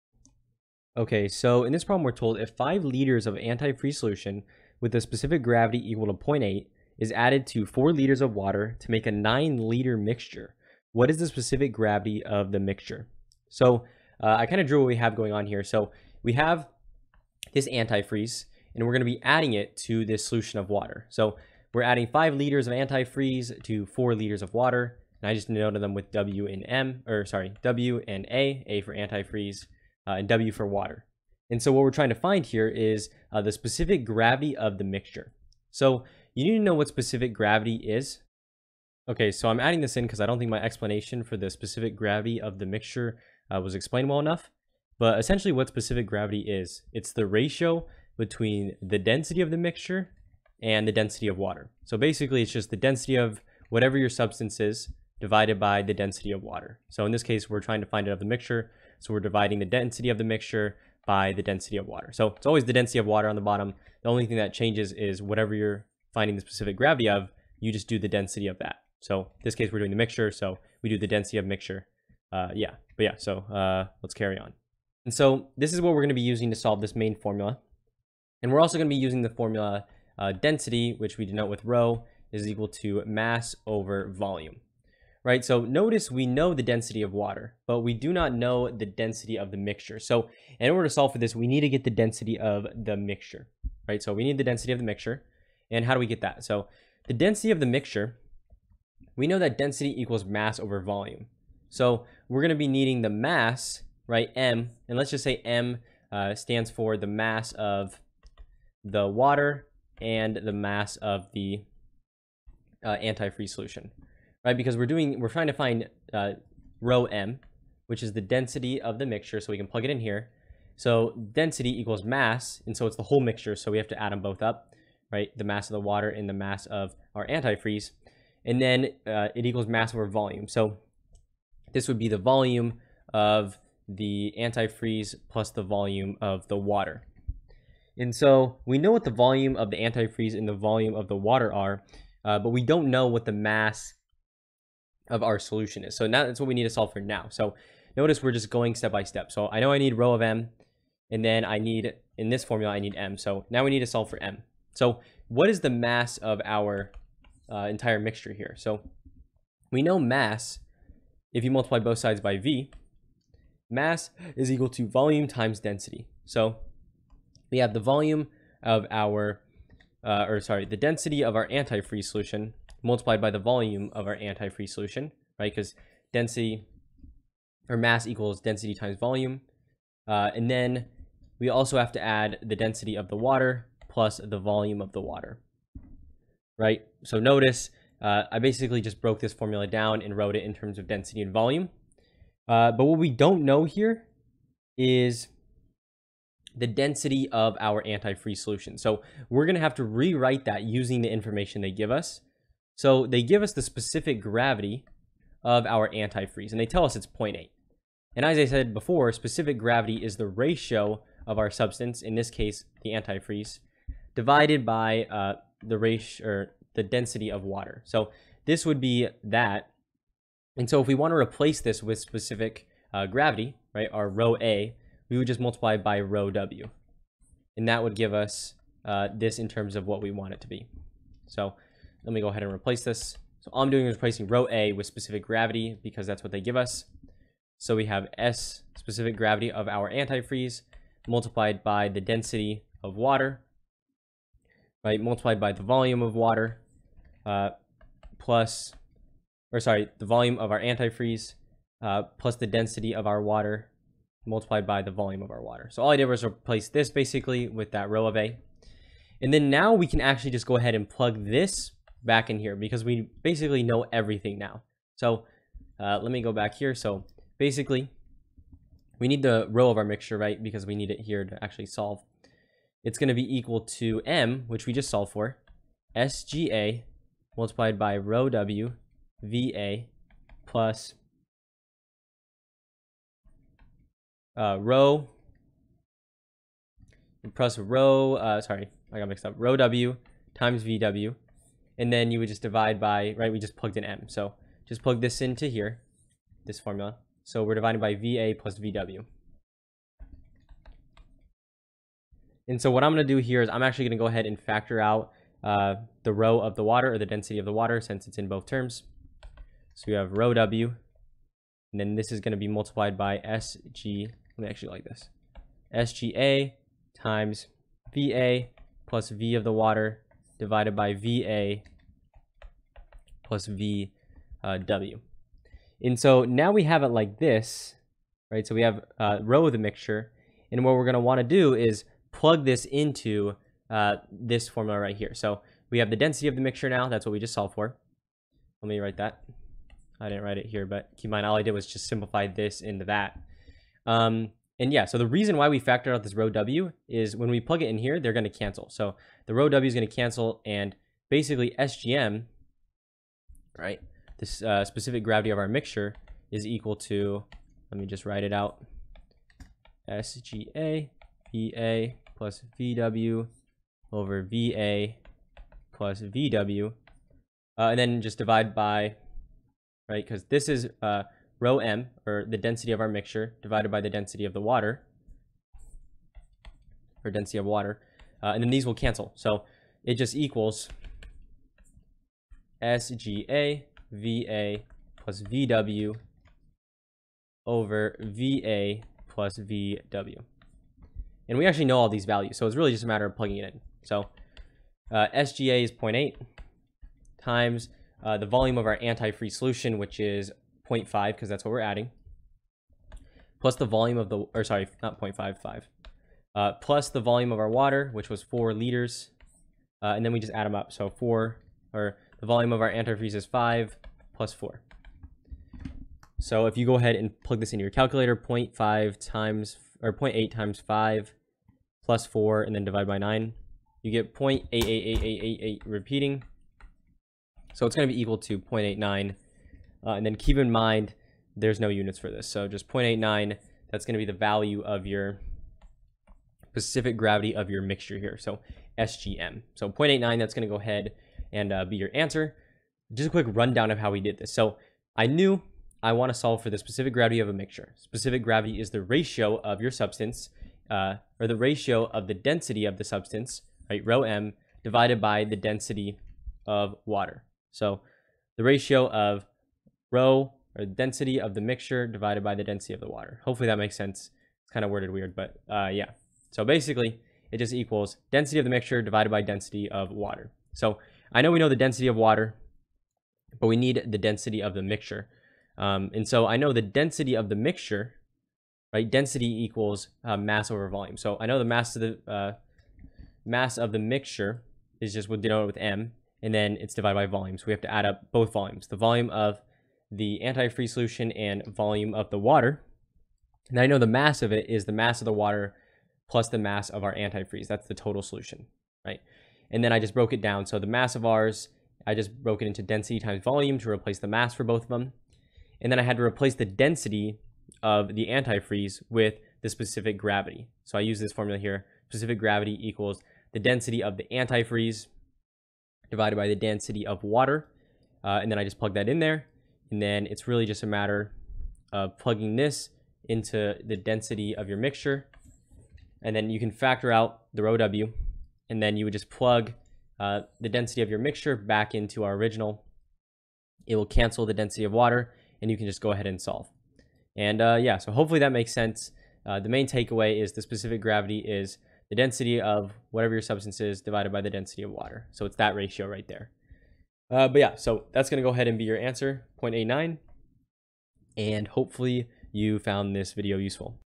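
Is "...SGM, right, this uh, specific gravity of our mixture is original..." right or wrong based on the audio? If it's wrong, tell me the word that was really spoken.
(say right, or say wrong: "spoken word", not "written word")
wrong: "equal", not "original".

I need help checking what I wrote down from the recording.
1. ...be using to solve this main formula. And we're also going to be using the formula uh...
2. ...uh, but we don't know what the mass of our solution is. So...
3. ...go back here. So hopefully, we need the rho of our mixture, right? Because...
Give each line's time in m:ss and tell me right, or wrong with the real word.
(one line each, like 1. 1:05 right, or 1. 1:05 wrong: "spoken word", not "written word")
1. 1:16 right
2. 2:22 right
3. 4:26 wrong: "basically", not "hopefully".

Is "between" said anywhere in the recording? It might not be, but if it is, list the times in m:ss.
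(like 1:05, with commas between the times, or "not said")
0:48.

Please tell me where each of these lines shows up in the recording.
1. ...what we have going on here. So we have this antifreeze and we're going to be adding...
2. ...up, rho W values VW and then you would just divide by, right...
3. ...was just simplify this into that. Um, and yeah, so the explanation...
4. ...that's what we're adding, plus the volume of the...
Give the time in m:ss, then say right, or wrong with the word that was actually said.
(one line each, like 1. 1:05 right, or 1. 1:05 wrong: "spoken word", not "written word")
1. 0:14 right
2. 4:49 wrong: "times", not "values"
3. 5:41 wrong: "reason", not "explanation"
4. 6:41 right.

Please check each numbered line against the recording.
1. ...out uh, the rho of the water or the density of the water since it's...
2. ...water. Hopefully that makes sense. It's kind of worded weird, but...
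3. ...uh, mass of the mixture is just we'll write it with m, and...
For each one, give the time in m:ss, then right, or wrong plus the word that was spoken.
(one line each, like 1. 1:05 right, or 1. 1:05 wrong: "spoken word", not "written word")
1. 5:04 right
2. 7:42 right
3. 8:02 wrong: "denote", not "write".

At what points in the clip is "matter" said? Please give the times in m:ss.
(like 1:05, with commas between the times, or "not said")
6:32, 8:40.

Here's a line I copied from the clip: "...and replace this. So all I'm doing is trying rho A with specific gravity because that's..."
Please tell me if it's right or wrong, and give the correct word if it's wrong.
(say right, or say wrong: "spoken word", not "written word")
wrong: "replacing", not "trying".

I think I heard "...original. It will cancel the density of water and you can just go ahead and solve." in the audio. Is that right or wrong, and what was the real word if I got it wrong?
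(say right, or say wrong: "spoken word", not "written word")
right.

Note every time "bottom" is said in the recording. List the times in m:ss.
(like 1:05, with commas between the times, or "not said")
1:03.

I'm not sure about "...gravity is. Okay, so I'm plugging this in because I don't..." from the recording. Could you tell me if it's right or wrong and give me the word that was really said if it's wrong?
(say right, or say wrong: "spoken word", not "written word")
wrong: "adding", not "plugging".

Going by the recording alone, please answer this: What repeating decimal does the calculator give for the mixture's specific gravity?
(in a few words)
0.888888 repeating.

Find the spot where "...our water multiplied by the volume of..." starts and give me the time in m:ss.
4:13.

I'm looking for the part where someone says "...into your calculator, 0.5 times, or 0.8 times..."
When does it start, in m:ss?
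6:57.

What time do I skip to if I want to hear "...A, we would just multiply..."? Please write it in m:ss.
3:44.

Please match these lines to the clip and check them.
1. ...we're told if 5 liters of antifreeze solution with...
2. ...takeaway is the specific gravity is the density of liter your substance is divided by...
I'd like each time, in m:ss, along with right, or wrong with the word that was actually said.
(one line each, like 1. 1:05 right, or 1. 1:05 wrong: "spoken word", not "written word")
1. 0:02 right
2. 8:59 wrong: "whatever", not "liter".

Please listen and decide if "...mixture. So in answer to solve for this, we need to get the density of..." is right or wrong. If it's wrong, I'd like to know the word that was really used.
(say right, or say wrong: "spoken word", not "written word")
wrong: "order", not "answer".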